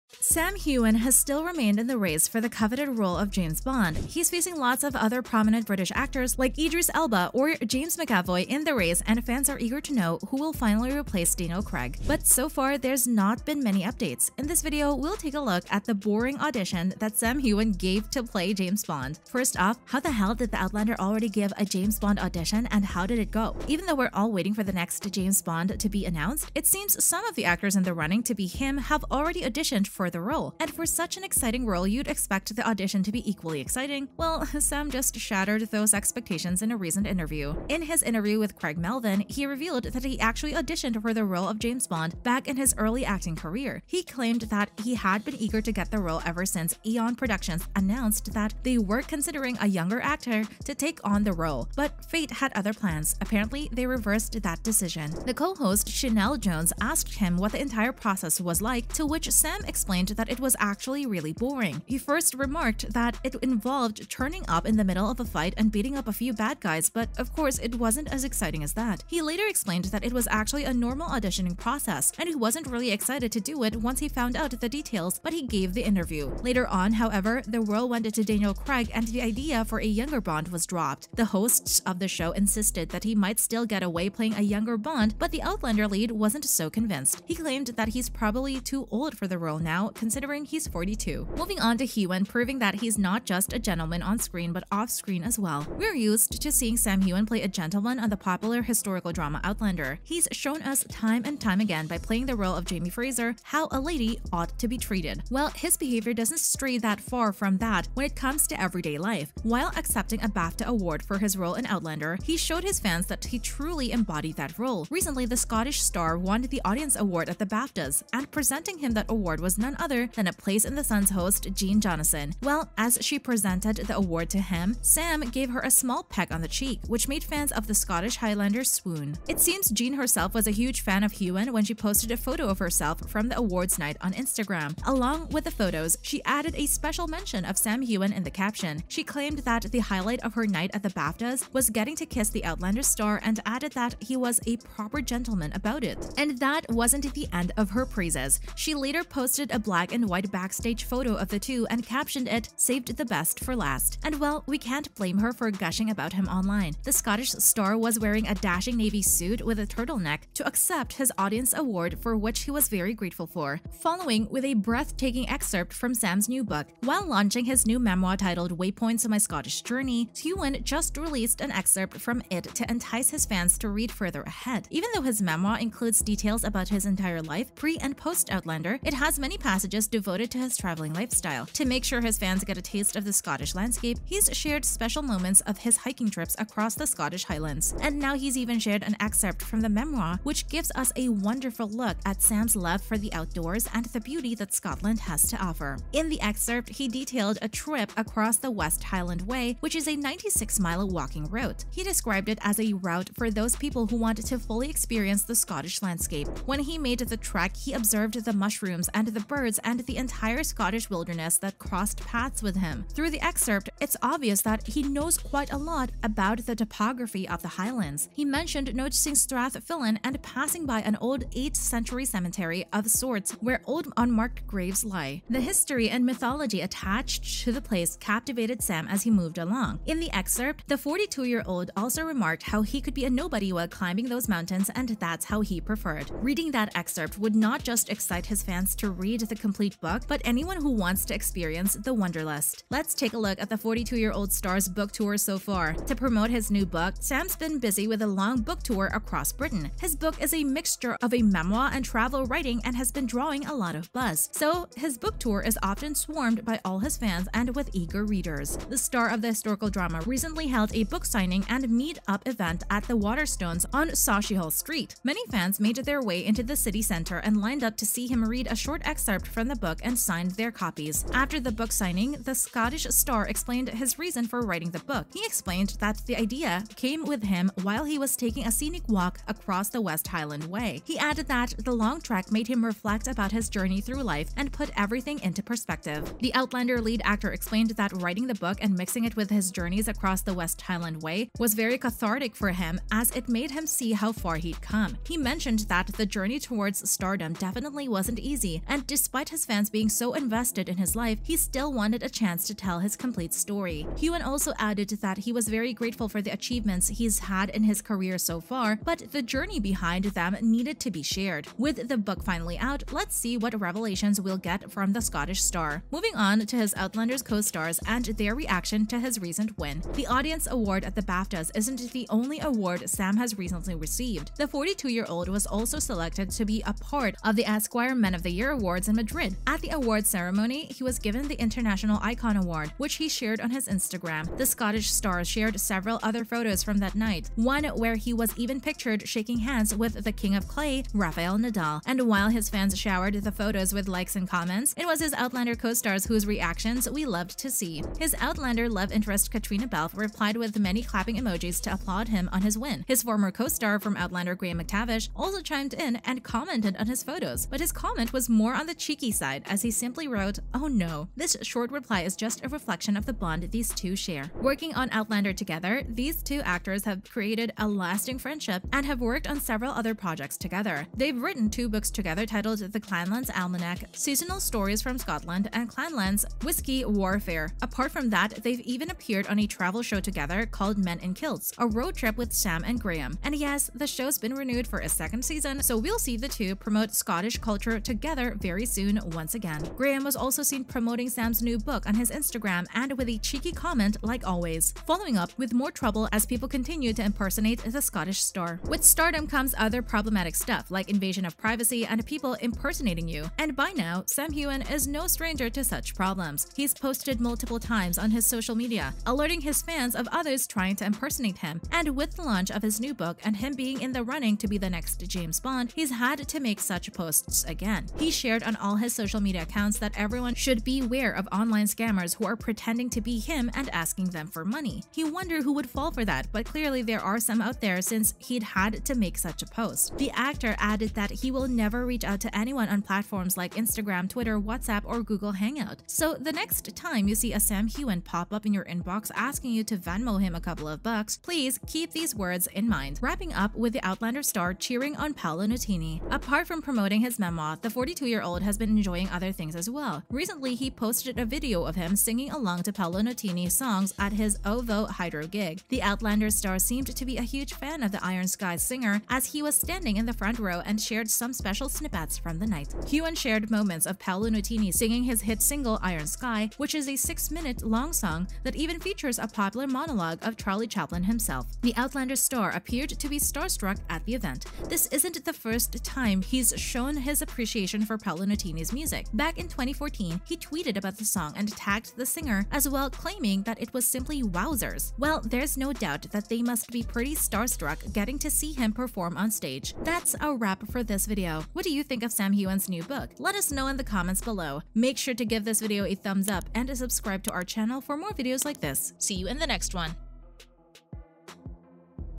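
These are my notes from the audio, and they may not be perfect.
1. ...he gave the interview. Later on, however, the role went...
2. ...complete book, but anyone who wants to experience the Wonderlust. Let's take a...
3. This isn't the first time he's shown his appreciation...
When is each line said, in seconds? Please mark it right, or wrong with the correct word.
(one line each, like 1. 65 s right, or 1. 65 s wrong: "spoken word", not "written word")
1. 75 s right
2. 239 s right
3. 474 s right.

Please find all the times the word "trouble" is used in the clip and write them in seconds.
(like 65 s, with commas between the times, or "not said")
395 s.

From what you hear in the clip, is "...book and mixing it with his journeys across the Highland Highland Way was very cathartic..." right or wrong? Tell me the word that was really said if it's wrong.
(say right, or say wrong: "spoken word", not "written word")
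wrong: "West", not "Highland".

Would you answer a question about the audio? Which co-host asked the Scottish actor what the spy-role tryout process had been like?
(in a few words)
Sheinelle Jones.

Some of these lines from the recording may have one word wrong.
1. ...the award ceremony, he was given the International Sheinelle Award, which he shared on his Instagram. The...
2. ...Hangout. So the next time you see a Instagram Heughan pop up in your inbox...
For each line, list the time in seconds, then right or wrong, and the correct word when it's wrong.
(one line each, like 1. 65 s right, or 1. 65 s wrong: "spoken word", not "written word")
1. 329 s wrong: "Icon", not "Sheinelle"
2. 435 s wrong: "Sam", not "Instagram".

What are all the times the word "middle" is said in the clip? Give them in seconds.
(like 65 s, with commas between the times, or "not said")
64 s.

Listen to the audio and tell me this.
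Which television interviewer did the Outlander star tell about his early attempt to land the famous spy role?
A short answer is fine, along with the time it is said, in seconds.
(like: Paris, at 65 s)
Craig Melvin, at 38 s.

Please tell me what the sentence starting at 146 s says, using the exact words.
And that wasn't the end of her praises.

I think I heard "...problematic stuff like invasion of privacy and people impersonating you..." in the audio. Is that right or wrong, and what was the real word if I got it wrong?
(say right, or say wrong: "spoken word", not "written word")
right.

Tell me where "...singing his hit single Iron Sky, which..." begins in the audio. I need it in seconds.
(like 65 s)
464 s.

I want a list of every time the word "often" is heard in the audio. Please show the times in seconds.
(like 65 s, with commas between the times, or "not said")
255 s.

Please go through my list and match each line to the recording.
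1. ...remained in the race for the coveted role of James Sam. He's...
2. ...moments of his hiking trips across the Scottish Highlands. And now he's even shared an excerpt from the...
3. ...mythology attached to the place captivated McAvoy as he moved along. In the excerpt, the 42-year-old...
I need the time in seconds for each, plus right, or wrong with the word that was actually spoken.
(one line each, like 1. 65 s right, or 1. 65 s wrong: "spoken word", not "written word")
1. 1 s wrong: "Bond", not "Sam"
2. 185 s right
3. 226 s wrong: "Sam", not "McAvoy".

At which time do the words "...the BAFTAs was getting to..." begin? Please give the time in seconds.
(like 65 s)
140 s.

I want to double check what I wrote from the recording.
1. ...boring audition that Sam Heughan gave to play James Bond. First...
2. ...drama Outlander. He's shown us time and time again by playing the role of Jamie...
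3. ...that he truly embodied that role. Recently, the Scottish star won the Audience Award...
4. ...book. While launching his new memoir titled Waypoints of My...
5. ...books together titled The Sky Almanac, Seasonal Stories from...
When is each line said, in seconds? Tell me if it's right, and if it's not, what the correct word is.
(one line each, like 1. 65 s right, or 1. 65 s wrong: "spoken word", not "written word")
1. 15 s right
2. 99 s right
3. 113 s right
4. 166 s right
5. 371 s wrong: "Clanlands", not "Sky".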